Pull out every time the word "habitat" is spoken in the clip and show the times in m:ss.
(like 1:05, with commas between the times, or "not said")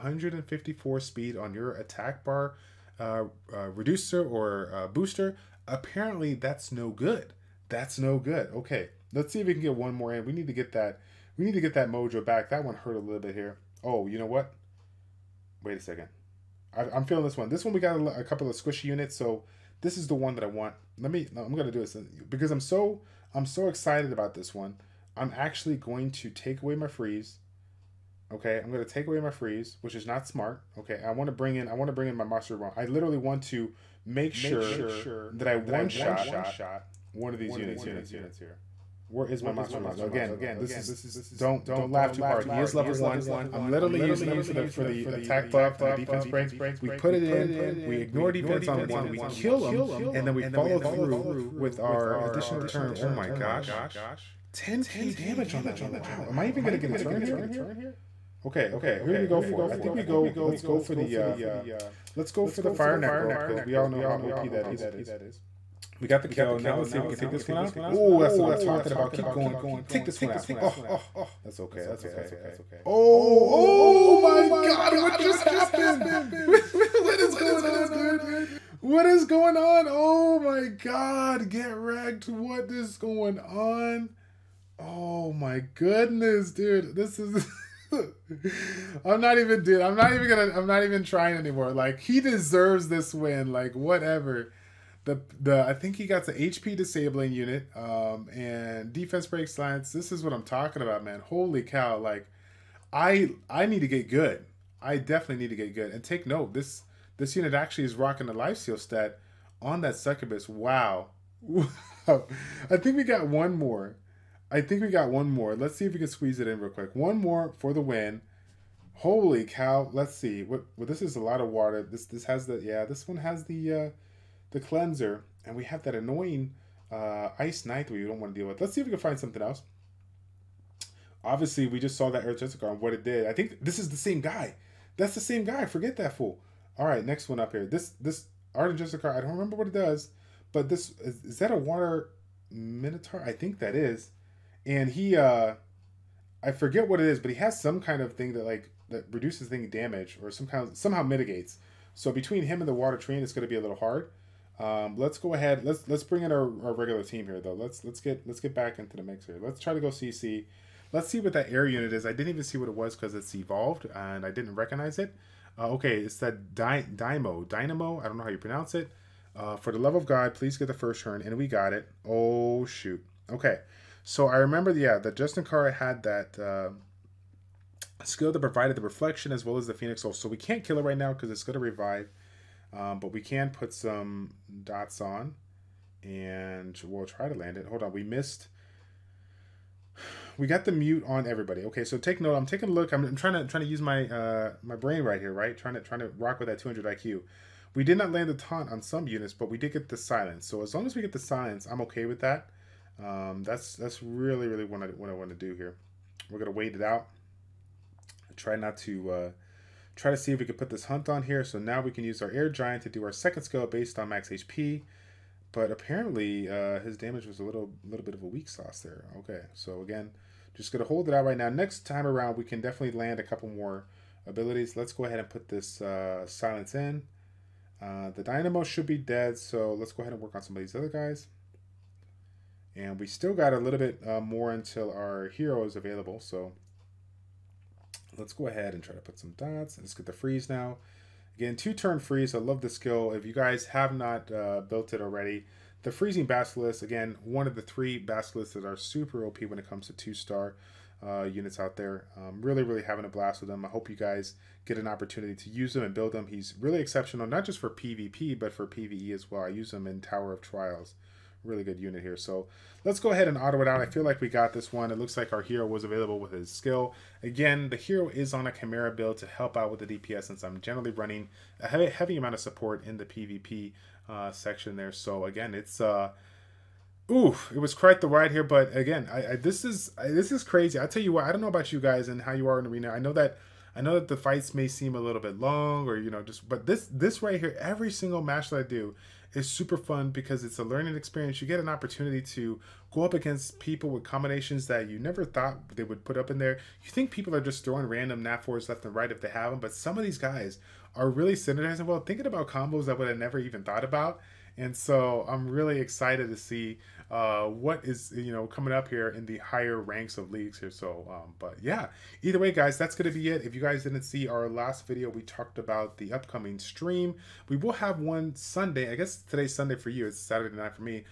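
not said.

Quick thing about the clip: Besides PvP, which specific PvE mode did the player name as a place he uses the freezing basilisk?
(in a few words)
Tower of Trials.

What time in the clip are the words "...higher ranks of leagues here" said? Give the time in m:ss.
5:09.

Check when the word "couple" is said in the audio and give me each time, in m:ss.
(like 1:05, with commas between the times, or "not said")
0:18, 3:43.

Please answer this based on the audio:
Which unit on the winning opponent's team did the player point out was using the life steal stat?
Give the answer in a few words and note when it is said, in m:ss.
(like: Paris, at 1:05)
succubus, at 1:49.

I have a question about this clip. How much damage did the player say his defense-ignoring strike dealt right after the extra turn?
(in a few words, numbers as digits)
10k.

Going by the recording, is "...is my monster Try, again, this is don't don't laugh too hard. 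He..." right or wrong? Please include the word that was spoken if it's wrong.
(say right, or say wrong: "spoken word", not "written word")
wrong: "Now", not "Try".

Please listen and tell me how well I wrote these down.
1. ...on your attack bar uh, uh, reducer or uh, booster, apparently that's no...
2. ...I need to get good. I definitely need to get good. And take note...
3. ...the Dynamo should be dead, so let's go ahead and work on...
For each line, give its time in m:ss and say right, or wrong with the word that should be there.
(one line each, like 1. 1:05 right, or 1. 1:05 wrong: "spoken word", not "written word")
1. 0:01 right
2. 1:43 right
3. 3:48 right.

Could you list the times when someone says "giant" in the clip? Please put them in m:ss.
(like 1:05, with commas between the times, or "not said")
3:32.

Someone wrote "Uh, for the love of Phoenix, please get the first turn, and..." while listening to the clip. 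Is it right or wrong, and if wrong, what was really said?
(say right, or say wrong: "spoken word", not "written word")
wrong: "God", not "Phoenix".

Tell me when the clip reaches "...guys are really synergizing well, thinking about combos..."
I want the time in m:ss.
5:00.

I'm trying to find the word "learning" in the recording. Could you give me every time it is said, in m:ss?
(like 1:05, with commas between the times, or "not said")
4:50.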